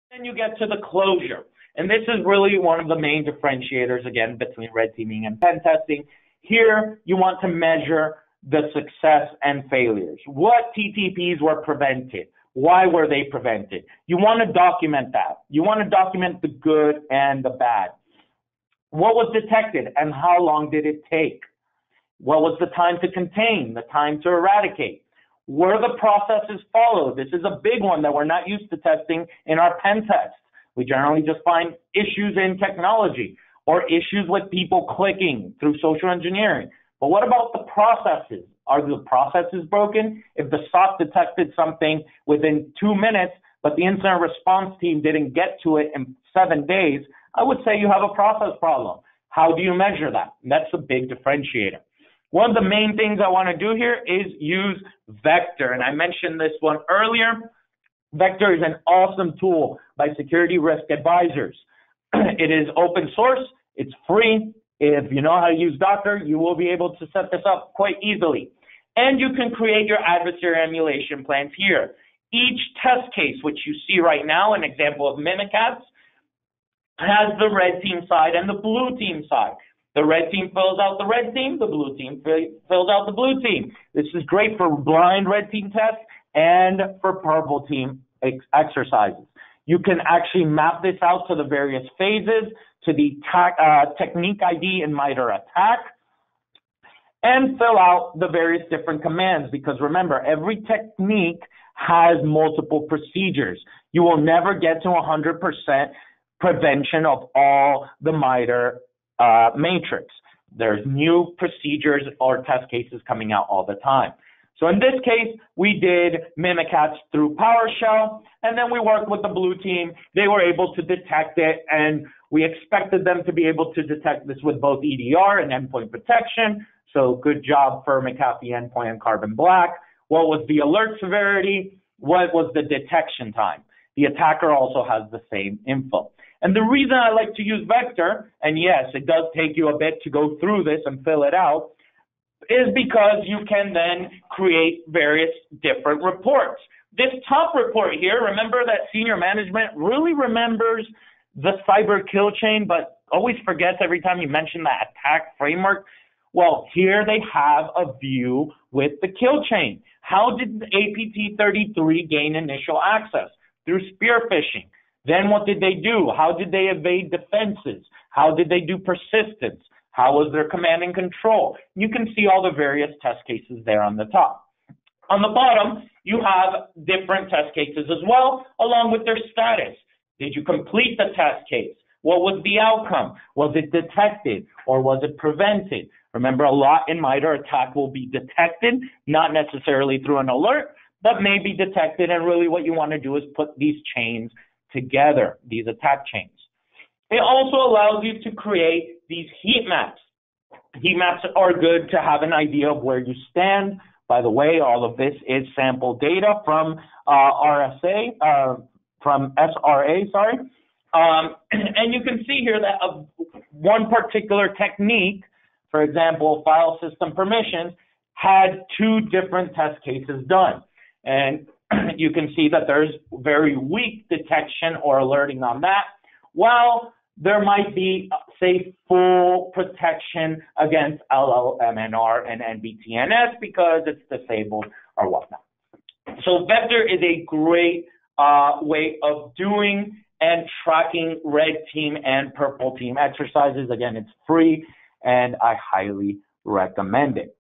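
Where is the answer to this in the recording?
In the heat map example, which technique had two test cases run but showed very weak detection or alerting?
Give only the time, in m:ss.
3:36.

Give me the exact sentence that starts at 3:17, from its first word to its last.
It also allows you to create these heat maps.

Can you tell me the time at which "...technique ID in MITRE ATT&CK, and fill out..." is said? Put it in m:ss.
1:34.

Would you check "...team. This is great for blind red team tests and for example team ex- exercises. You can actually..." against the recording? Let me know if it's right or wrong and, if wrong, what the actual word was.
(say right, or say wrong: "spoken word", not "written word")
wrong: "purple", not "example".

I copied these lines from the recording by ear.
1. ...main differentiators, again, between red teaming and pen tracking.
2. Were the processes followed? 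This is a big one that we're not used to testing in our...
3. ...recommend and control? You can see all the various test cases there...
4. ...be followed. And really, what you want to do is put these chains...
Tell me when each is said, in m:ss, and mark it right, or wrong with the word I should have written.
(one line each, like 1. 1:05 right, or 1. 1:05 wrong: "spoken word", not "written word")
1. 0:02 wrong: "testing", not "tracking"
2. 0:25 right
3. 2:50 wrong: "command", not "recommend"
4. 3:11 wrong: "detected", not "followed".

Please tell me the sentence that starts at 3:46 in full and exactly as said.
While there might be, say, full protection against LLMNR and NBTNS because it's disabled or whatnot.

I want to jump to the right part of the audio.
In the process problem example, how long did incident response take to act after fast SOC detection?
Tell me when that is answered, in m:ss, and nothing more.
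0:46.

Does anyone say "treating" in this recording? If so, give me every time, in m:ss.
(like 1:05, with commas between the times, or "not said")
not said.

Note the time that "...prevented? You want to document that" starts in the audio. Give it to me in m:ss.
0:13.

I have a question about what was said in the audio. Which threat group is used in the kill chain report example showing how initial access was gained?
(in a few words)
APT 33.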